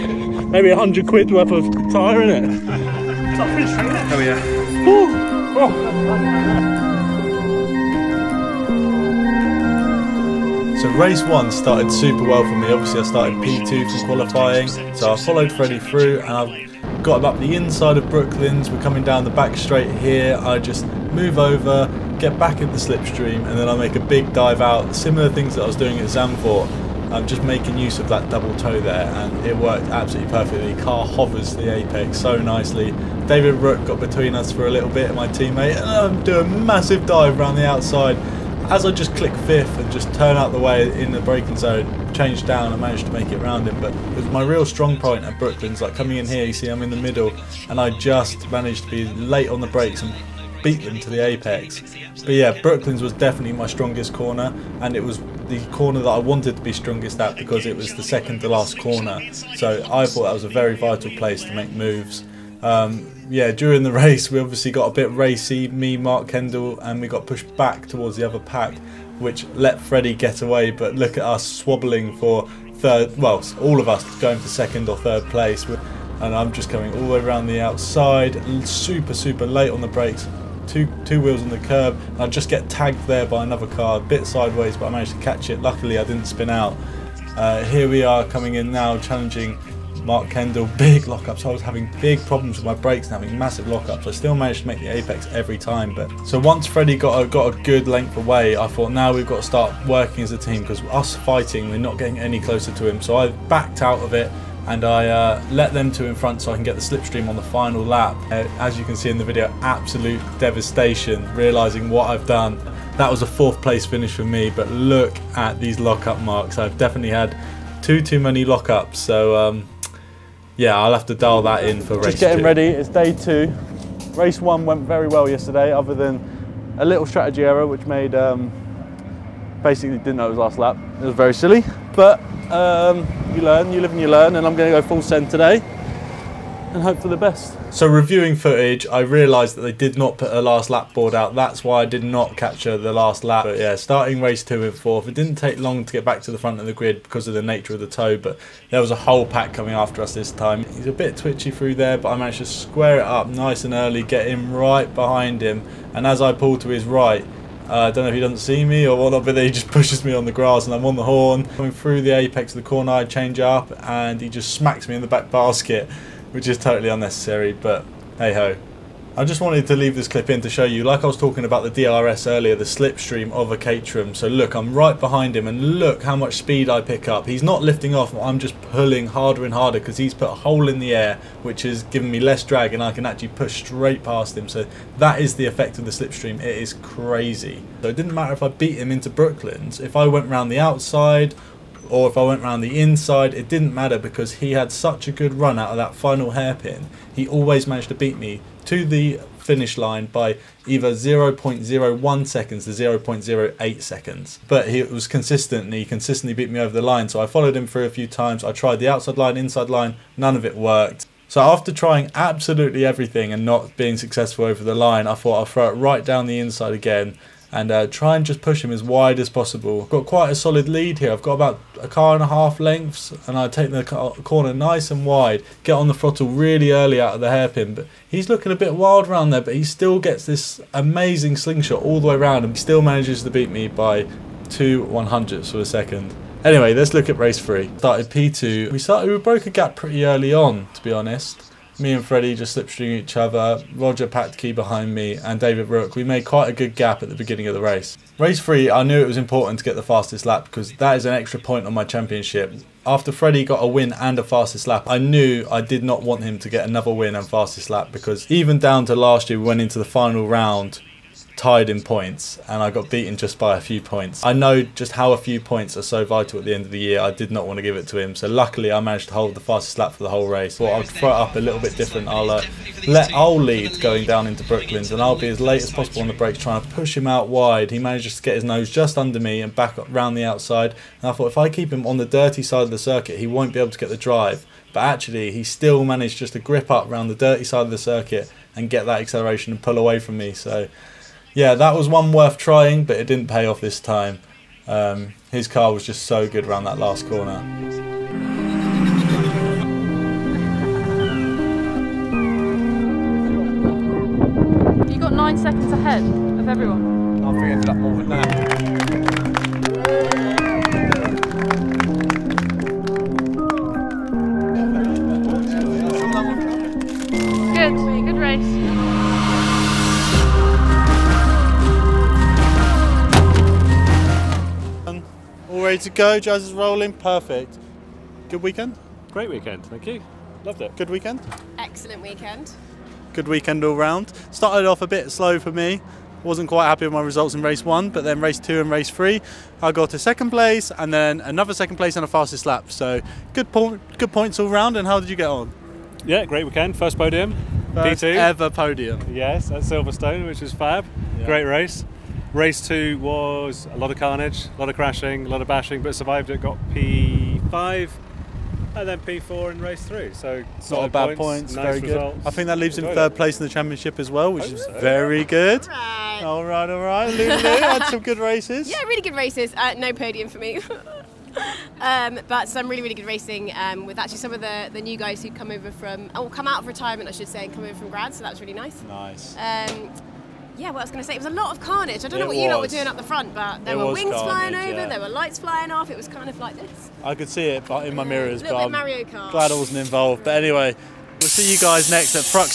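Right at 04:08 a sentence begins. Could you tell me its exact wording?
Race 3, I knew it was important to get the fastest lap because that is an extra point on my championship.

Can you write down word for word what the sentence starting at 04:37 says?
He manages to get his nose just under me and back round the outside.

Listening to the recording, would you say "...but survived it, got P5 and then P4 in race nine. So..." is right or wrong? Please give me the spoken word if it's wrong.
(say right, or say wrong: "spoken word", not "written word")
wrong: "three", not "nine".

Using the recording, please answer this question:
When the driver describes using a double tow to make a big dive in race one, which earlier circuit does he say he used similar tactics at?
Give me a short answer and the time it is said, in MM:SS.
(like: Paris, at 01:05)
Zandvoort, at 00:26.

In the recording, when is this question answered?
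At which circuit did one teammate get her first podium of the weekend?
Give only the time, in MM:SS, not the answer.
05:49.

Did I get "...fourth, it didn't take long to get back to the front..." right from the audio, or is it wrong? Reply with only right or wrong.
right.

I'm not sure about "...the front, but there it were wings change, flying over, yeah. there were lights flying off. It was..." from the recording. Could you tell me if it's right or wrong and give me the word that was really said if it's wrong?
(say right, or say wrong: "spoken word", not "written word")
wrong: "carnage", not "change".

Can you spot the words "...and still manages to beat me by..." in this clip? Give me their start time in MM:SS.
03:52.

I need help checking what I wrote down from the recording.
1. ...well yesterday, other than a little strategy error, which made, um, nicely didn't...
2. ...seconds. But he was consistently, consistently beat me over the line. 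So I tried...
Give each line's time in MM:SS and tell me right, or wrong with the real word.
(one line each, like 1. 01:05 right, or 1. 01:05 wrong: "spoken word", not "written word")
1. 02:05 wrong: "basically", not "nicely"
2. 03:23 wrong: "followed", not "tried".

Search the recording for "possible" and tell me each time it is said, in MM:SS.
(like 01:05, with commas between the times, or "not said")
03:39, 04:35.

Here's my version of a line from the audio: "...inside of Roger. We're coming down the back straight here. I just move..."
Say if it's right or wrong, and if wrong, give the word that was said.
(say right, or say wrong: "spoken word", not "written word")
wrong: "Brooklands", not "Roger".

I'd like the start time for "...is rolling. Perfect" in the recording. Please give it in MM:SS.
05:26.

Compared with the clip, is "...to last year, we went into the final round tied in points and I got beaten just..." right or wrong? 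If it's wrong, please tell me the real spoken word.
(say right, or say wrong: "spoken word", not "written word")
right.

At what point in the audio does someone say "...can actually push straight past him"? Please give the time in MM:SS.
03:02.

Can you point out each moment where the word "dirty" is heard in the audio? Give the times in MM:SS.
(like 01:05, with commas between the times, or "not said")
04:42, 04:47.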